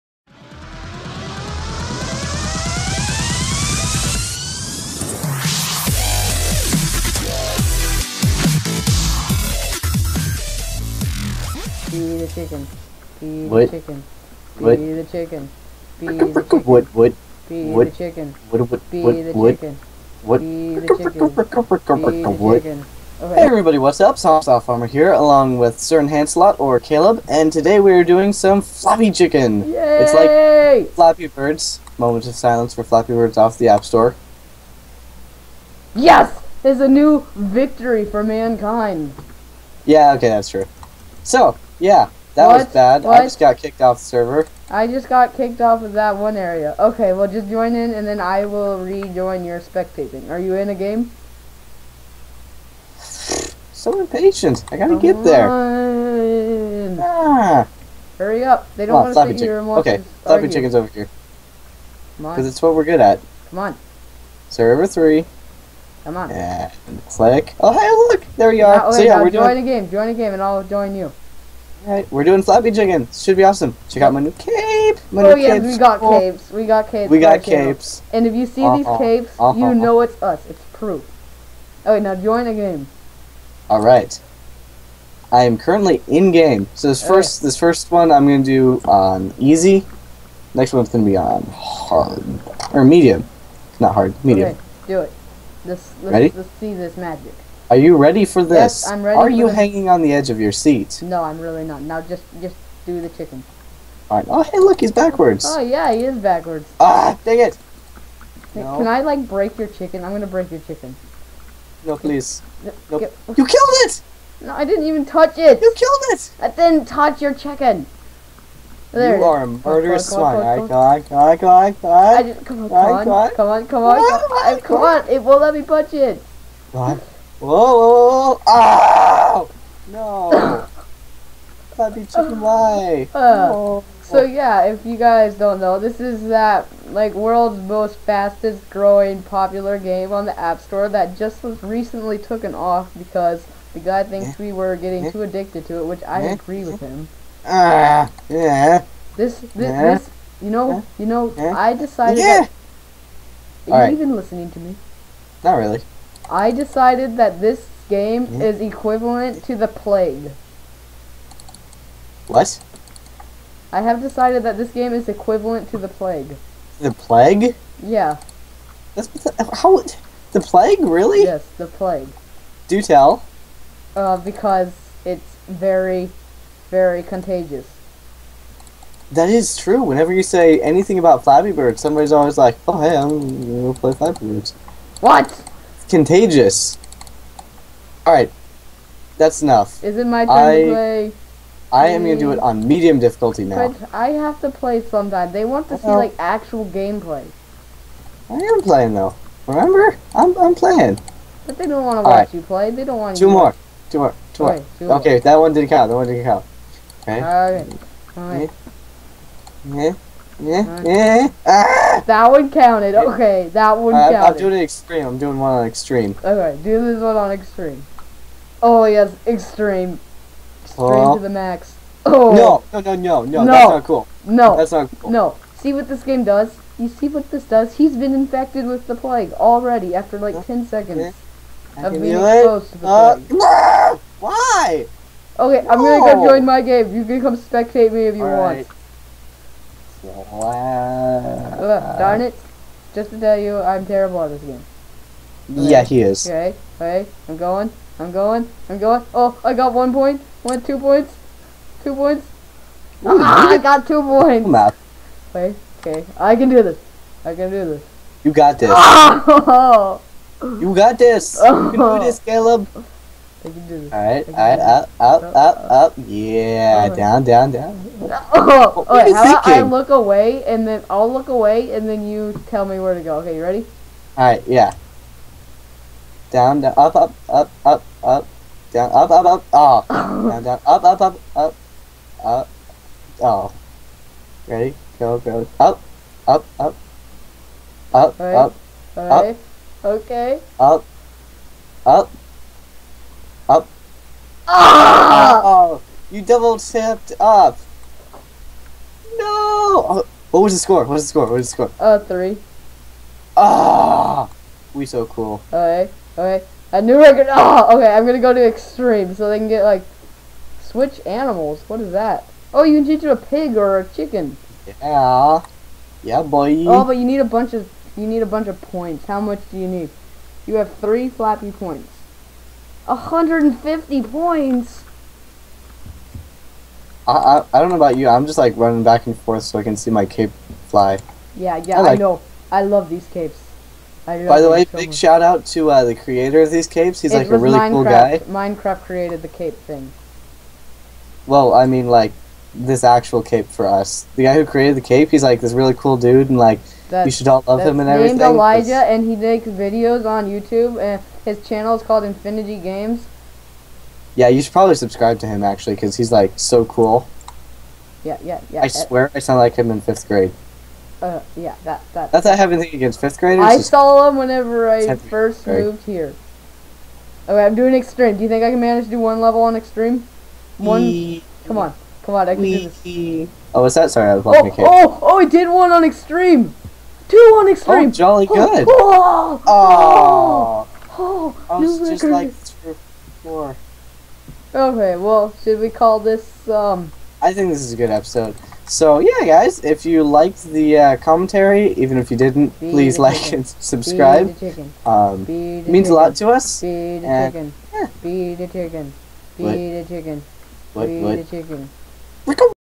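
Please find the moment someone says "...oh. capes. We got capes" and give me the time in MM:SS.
01:16.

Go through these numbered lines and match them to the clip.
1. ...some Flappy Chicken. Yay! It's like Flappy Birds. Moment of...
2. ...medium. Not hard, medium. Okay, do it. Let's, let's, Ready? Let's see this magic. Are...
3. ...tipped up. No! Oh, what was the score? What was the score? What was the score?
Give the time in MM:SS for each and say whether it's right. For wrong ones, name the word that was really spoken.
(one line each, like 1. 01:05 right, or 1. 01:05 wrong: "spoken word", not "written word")
1. 00:28 right
2. 01:32 right
3. 04:56 right.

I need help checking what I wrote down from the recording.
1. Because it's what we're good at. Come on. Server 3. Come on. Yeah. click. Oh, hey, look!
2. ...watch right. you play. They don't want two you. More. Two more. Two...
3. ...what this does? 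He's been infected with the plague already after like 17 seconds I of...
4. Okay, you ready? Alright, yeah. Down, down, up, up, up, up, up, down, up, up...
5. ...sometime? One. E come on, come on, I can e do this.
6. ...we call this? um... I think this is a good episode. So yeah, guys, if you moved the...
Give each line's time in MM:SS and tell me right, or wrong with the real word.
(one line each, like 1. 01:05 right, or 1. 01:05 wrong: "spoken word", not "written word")
1. 01:02 right
2. 03:22 right
3. 03:47 wrong: "10", not "17"
4. 04:33 right
5. 06:09 wrong: "extreme", not "sometime"
6. 06:25 wrong: "liked", not "moved".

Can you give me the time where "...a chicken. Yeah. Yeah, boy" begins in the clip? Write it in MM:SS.
05:13.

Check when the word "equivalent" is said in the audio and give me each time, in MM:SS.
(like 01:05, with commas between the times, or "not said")
02:38, 02:45.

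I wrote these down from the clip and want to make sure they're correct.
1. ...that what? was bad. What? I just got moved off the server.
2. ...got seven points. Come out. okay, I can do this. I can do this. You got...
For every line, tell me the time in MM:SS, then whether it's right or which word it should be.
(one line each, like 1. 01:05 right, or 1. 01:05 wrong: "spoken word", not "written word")
1. 00:42 wrong: "kicked", not "moved"
2. 04:13 wrong: "two", not "seven".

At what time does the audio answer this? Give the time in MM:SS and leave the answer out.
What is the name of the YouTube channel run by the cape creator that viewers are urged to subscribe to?
05:52.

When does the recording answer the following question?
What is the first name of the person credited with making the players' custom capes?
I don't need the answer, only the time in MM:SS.
05:48.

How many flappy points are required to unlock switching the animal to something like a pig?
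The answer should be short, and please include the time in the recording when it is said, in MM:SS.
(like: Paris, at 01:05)
150, at 05:22.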